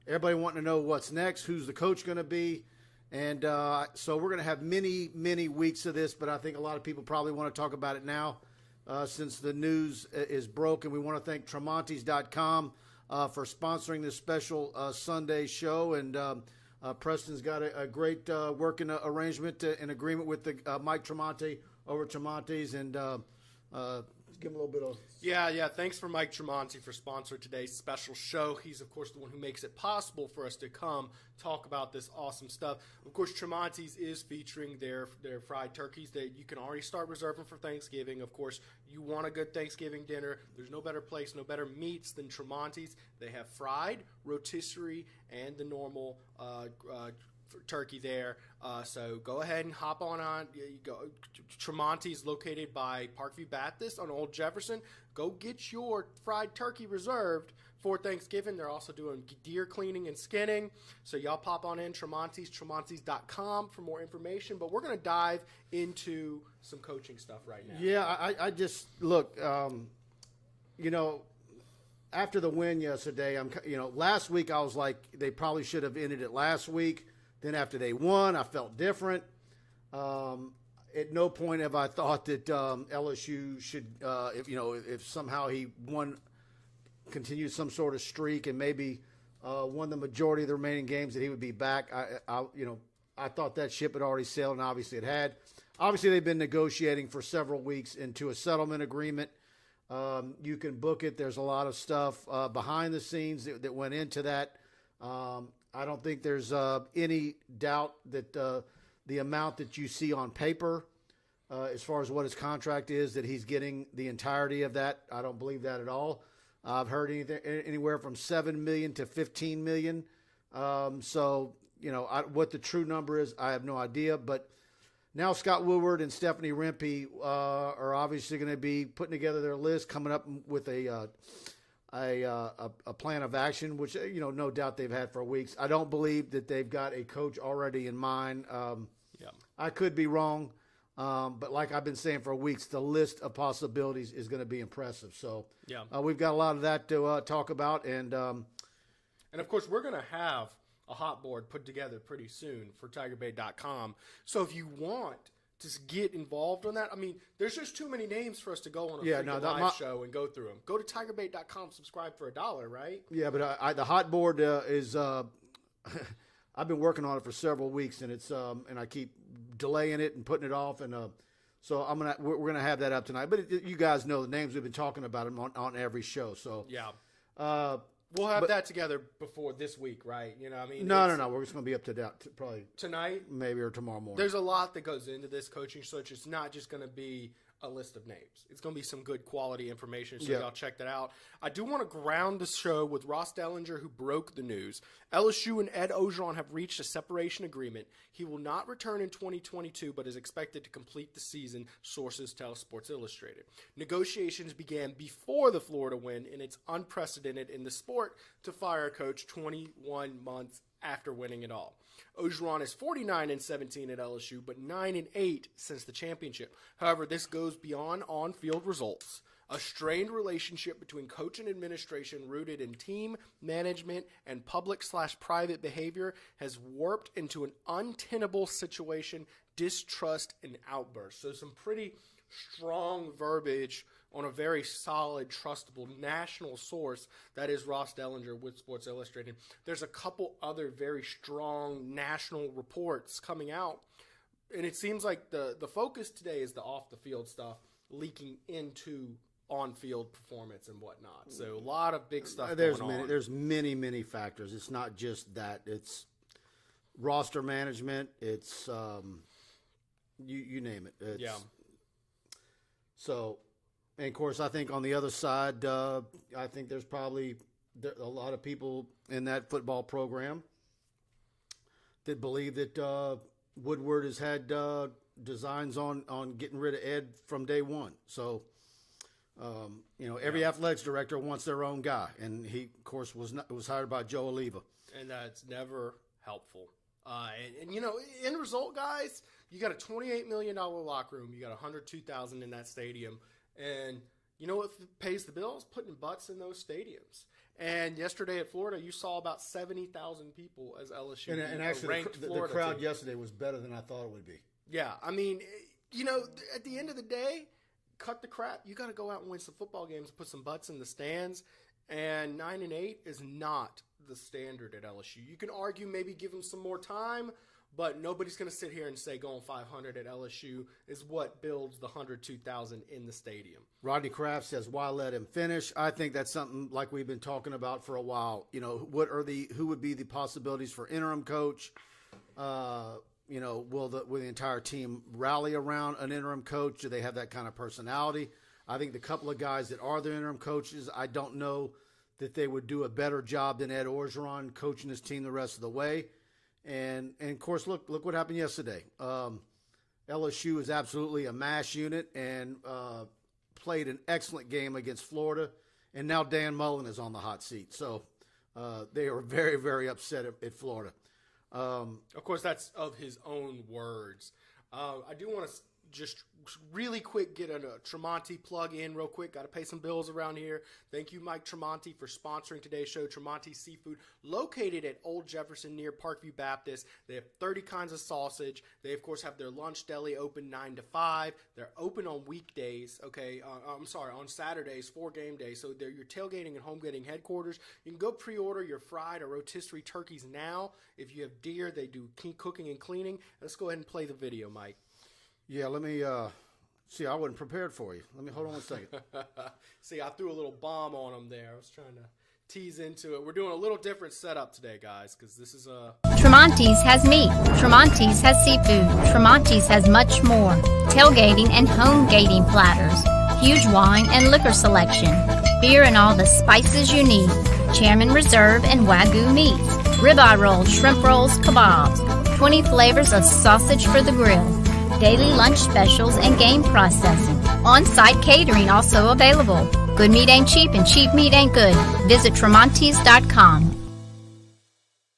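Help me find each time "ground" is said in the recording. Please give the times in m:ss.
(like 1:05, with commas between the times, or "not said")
3:11.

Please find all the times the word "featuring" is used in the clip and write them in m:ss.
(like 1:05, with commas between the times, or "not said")
0:34.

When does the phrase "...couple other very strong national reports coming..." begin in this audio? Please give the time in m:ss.
3:59.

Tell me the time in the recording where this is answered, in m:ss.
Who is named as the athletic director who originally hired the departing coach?
4:44.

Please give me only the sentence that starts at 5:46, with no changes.
And and of course, look look what happened yesterday.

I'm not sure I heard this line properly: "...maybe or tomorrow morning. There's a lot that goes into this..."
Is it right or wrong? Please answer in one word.
right.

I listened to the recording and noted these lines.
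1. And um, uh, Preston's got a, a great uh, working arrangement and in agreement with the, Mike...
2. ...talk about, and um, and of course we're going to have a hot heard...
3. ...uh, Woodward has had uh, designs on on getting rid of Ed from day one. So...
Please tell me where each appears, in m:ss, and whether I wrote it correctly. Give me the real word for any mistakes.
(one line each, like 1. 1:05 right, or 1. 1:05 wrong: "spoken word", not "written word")
1. 0:15 right
2. 2:27 wrong: "board", not "heard"
3. 4:32 right.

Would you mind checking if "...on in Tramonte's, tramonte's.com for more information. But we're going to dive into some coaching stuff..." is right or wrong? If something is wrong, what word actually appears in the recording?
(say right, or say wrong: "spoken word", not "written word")
right.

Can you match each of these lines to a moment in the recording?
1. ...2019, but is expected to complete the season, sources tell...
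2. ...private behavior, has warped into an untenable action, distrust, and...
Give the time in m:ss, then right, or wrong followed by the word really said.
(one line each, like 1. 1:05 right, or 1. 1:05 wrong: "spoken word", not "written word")
1. 3:19 wrong: "2022", not "2019"
2. 3:45 wrong: "situation", not "action".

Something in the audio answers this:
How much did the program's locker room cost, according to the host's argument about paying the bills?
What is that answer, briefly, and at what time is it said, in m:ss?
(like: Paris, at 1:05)
$28 million, at 4:49.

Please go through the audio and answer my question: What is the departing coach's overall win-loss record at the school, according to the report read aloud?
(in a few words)
49-17.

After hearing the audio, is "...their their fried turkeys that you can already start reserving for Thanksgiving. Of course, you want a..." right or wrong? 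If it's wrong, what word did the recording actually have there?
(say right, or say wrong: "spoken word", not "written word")
right.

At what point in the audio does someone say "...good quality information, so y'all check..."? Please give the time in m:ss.
3:09.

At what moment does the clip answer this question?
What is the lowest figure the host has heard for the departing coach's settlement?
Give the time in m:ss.
1:58.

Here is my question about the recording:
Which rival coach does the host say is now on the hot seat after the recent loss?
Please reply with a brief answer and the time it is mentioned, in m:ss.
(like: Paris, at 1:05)
Dan Mullen, at 5:56.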